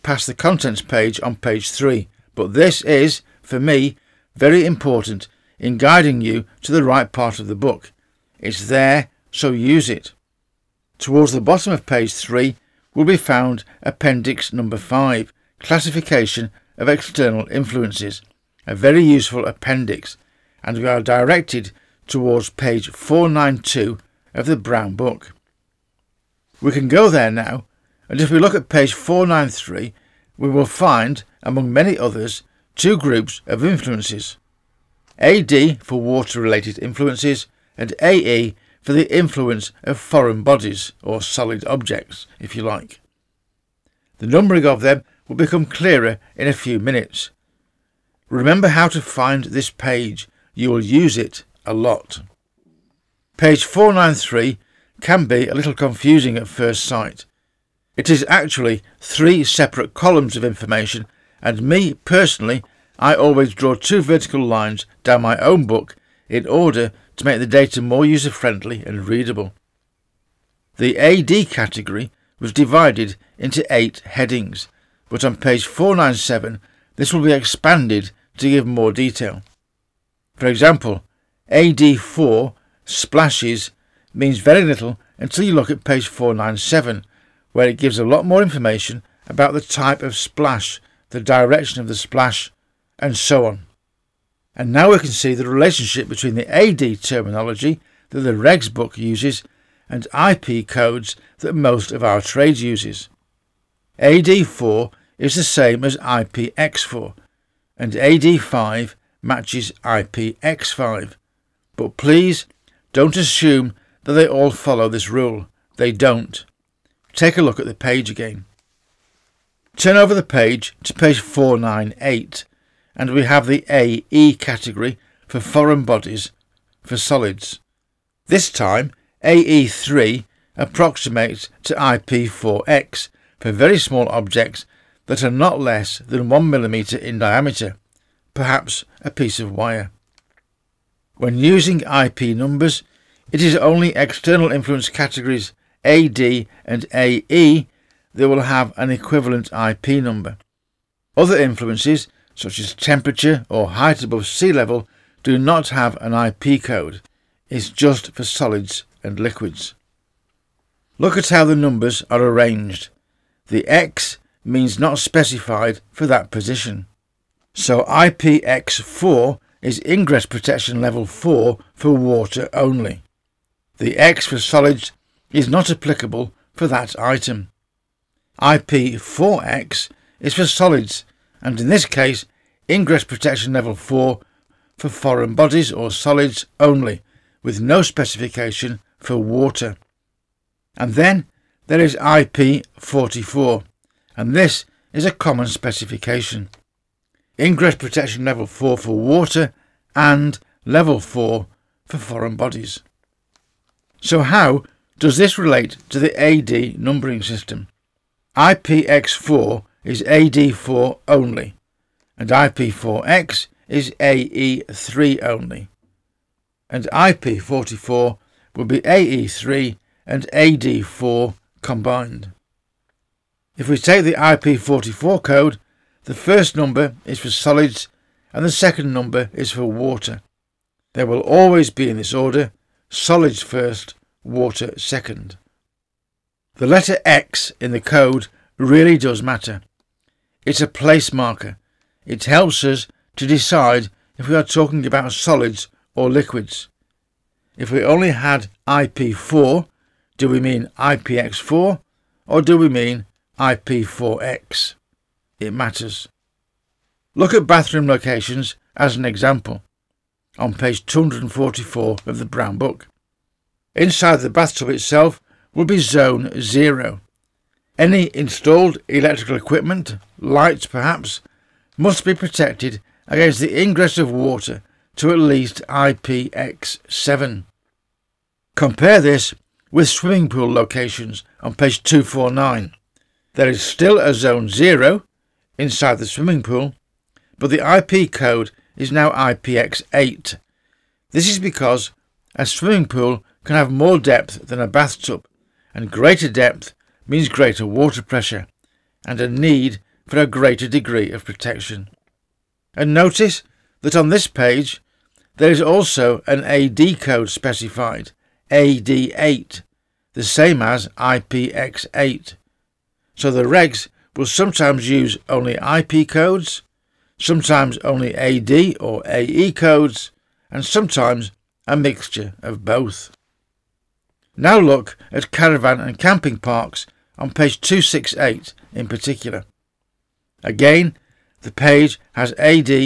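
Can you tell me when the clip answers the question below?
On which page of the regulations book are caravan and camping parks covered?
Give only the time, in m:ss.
5:27.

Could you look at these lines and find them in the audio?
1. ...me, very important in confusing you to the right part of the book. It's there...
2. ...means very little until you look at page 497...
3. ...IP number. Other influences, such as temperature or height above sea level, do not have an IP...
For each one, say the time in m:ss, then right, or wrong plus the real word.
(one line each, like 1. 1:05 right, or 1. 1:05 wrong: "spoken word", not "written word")
1. 0:03 wrong: "guiding", not "confusing"
2. 1:24 right
3. 2:29 right.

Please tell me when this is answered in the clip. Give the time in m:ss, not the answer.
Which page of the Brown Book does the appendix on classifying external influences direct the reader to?
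0:22.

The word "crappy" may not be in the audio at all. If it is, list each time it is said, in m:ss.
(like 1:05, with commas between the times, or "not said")
not said.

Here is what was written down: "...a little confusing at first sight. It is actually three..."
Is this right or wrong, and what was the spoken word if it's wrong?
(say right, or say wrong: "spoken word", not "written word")
right.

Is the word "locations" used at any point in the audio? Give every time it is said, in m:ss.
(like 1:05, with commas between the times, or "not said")
4:17, 4:40.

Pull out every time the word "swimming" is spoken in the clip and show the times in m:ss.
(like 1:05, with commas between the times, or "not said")
4:39, 4:46, 4:52.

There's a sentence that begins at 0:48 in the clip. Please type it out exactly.
Remember how to find this page.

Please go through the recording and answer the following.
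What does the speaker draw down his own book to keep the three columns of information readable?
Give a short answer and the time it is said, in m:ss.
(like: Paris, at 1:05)
two vertical lines, at 1:03.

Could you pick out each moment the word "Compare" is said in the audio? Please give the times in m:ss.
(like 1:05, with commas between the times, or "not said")
4:38.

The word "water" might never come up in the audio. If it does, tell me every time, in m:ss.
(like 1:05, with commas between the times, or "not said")
0:35, 2:51, 3:09, 3:18, 3:49, 3:54, 4:34, 4:57.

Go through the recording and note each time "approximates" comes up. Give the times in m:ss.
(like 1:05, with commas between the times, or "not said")
2:10.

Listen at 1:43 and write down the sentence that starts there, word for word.
AD4 is the same as IPX4, and AD5 matches IPX5.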